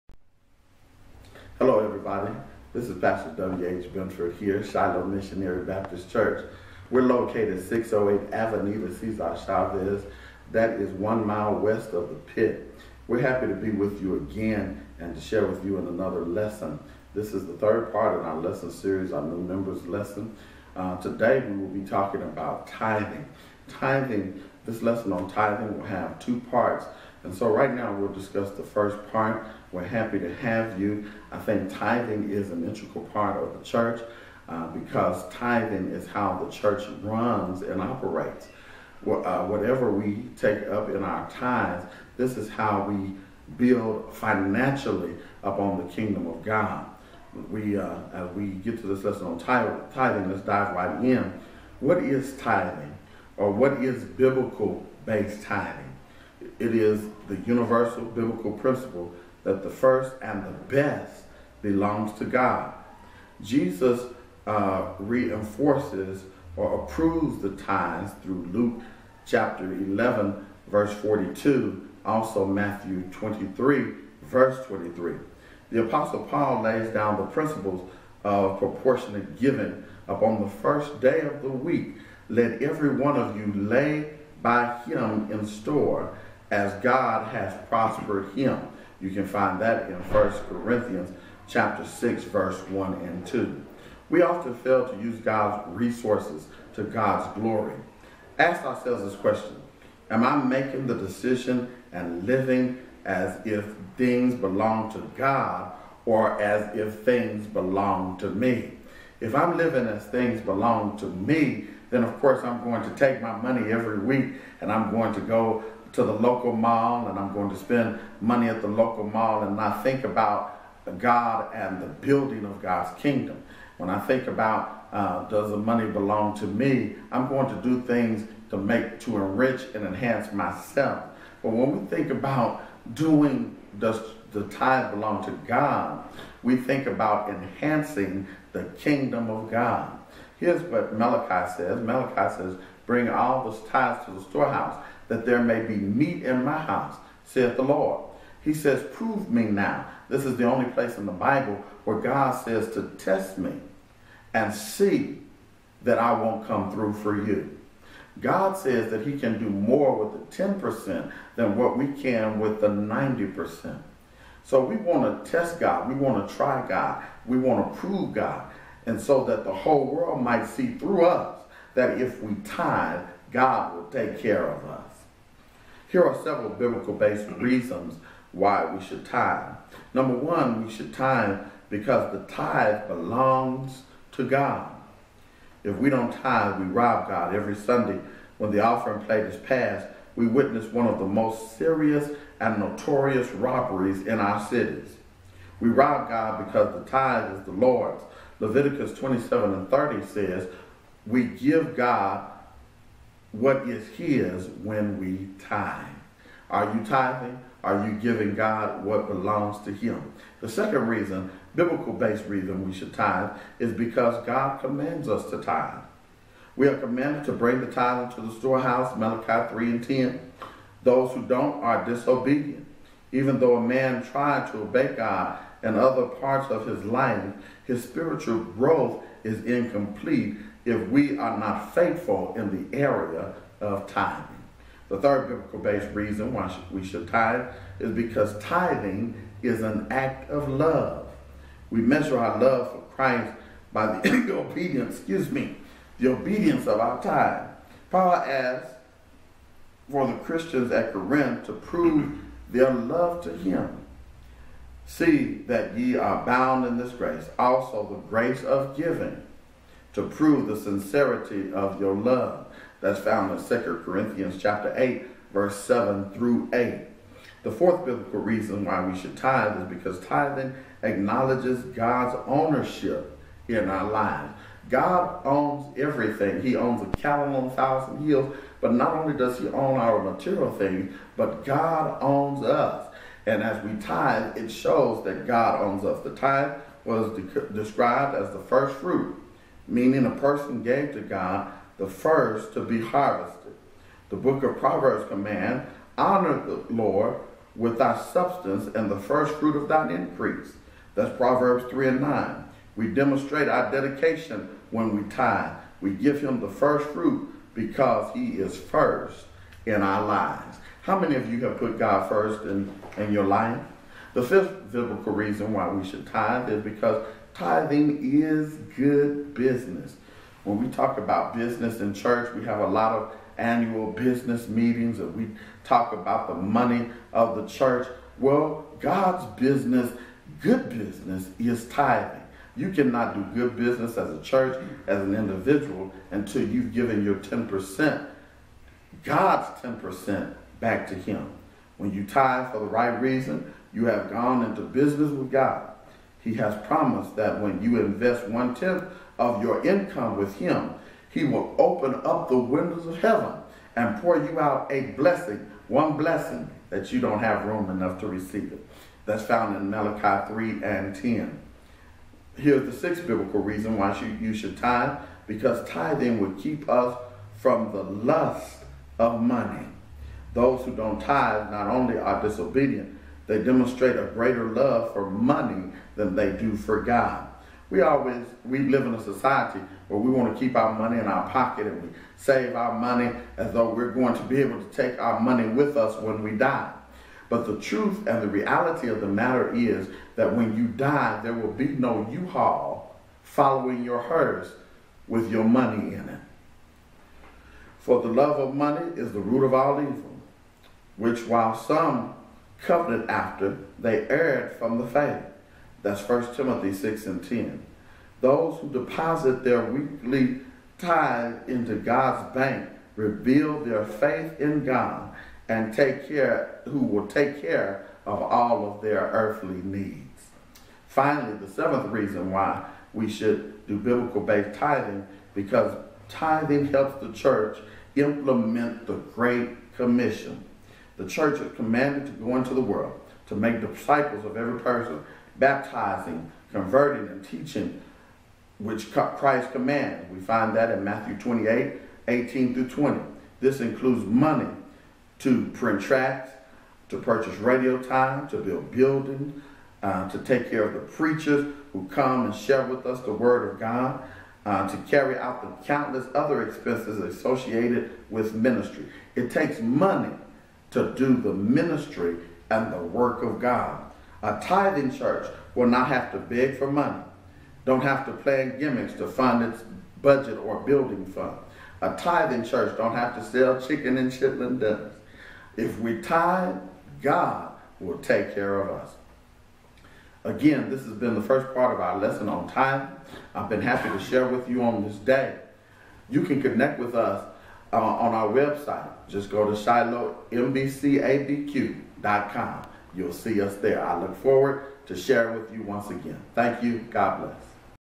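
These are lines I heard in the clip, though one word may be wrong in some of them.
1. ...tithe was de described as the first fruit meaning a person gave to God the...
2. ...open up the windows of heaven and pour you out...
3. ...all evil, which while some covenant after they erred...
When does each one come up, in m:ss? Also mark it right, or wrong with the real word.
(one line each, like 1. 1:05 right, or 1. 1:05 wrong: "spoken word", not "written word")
1. 4:46 right
2. 5:51 right
3. 6:39 right.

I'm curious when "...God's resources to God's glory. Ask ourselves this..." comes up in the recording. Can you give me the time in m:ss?
1:35.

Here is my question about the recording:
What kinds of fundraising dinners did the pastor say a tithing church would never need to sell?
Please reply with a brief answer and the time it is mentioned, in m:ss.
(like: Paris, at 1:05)
chicken and chitlin dinners, at 7:53.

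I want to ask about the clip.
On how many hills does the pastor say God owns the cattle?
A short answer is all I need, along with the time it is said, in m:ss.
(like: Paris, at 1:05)
1,000, at 4:37.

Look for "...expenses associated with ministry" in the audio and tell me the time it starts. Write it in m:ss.
7:36.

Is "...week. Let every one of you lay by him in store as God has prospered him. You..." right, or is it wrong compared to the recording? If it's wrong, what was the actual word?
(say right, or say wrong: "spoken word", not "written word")
right.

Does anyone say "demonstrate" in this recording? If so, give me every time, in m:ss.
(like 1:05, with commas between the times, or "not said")
5:02, 6:13.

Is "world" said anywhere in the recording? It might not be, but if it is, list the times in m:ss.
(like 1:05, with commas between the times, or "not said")
2:49, 7:12.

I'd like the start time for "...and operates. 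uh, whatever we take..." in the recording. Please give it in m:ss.
0:37.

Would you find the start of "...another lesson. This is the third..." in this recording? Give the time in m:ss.
0:15.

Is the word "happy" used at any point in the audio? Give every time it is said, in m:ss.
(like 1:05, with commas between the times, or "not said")
0:13, 0:29, 8:03.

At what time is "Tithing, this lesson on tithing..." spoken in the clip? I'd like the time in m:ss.
0:23.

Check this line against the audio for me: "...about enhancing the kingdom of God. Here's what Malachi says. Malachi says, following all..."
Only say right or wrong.
wrong.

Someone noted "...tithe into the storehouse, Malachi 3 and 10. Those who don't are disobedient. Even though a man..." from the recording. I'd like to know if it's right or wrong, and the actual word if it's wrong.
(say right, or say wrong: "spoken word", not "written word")
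right.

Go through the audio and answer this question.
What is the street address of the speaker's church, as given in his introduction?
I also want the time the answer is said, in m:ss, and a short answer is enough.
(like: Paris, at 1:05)
608 Avenida Cesar Chavez, at 0:07.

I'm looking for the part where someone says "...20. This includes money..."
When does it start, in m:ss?
7:22.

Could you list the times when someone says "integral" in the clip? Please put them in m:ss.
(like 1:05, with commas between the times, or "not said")
0:32.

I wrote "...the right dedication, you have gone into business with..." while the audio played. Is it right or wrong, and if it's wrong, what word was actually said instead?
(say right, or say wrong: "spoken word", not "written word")
wrong: "reason", not "dedication".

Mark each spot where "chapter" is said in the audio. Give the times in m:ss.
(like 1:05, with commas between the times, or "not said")
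1:09, 1:31, 4:24.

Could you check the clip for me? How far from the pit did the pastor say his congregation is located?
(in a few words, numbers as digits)
one mile west.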